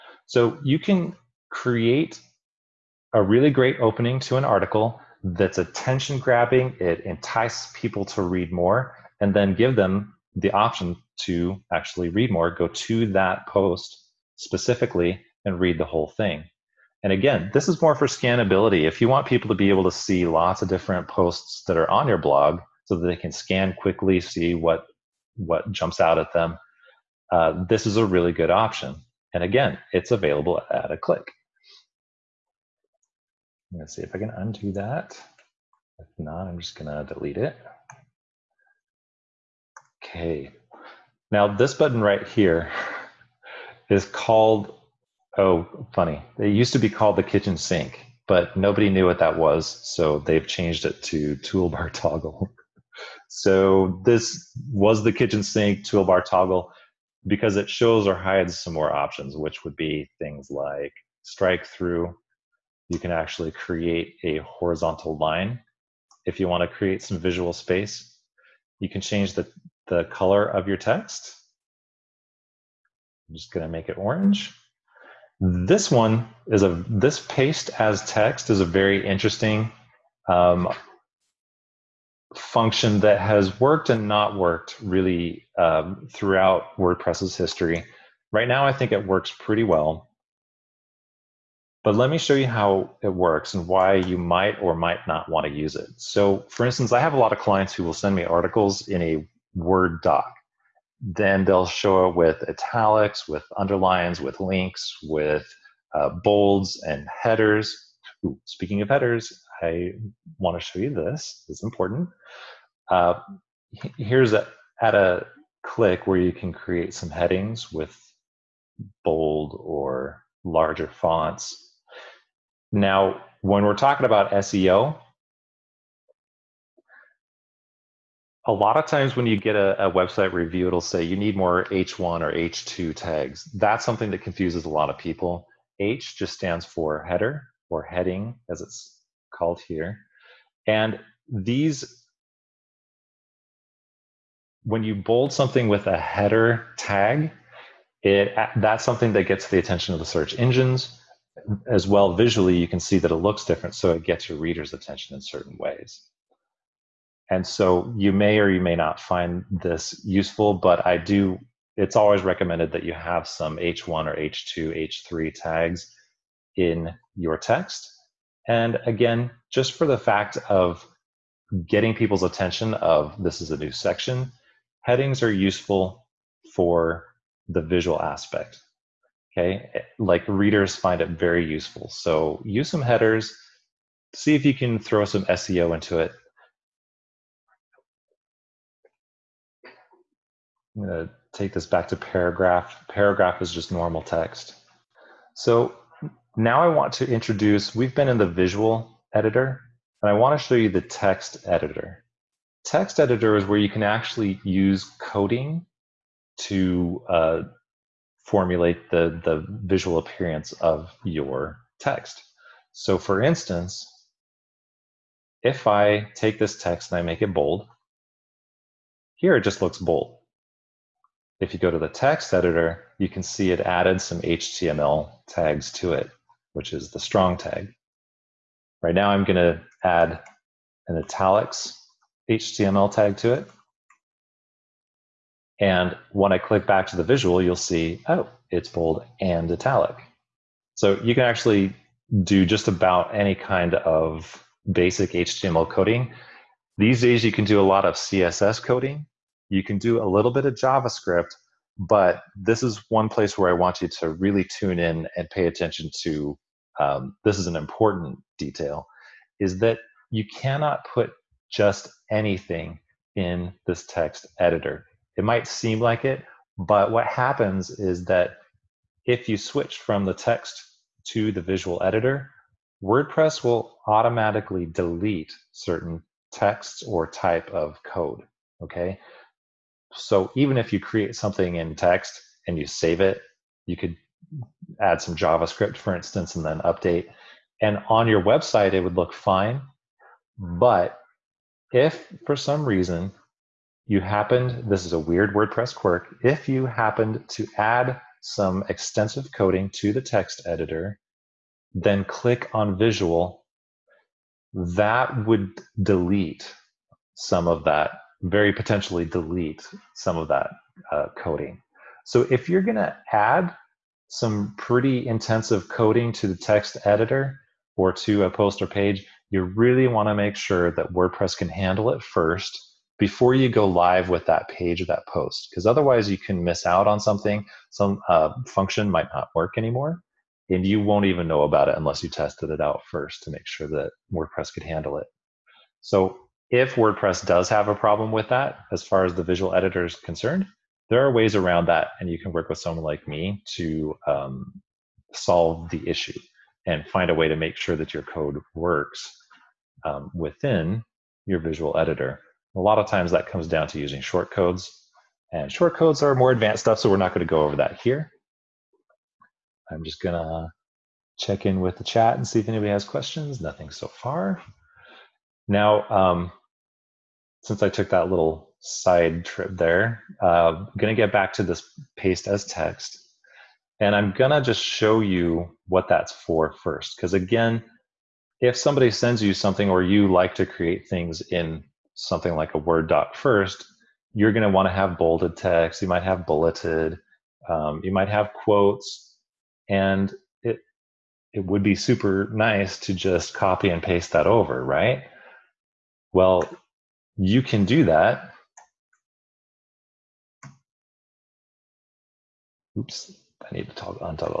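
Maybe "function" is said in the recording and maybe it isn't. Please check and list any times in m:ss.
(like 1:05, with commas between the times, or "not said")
1:22, 5:28.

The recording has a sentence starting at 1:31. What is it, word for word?
But let me show you how it works and why you might or might not want to use it.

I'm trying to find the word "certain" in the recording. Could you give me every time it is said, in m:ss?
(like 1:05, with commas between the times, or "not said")
2:35, 4:35.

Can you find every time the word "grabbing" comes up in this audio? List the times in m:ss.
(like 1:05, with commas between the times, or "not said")
0:06.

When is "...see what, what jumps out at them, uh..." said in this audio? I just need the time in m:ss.
0:24.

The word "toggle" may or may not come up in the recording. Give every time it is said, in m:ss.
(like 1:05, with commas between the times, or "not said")
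0:51, 0:56, 6:43.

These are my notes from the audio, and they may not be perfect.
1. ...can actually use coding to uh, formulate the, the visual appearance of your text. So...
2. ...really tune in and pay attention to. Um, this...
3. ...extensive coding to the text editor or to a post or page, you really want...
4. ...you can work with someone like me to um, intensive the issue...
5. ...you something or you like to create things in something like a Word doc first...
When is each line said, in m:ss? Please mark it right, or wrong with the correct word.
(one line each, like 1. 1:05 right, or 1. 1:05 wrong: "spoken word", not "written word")
1. 3:23 right
2. 4:14 right
3. 5:15 wrong: "intensive", not "extensive"
4. 5:42 wrong: "solve", not "intensive"
5. 6:19 right.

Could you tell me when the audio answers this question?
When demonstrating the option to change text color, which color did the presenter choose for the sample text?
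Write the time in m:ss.
1:13.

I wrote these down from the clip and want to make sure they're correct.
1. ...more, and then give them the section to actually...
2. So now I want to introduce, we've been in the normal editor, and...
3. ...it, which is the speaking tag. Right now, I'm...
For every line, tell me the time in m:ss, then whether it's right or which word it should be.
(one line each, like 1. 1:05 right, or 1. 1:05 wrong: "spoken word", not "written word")
1. 0:08 wrong: "option", not "section"
2. 3:15 wrong: "visual", not "normal"
3. 3:45 wrong: "strong", not "speaking".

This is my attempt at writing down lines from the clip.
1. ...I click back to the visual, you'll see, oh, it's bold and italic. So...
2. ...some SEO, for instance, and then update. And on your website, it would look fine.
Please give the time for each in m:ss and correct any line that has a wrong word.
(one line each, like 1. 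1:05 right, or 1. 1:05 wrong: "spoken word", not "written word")
1. 3:56 right
2. 4:45 wrong: "JavaScript", not "SEO".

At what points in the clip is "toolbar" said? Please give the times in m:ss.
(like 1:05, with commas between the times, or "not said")
0:51, 0:55.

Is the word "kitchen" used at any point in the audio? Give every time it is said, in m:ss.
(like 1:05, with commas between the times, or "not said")
0:47, 0:55.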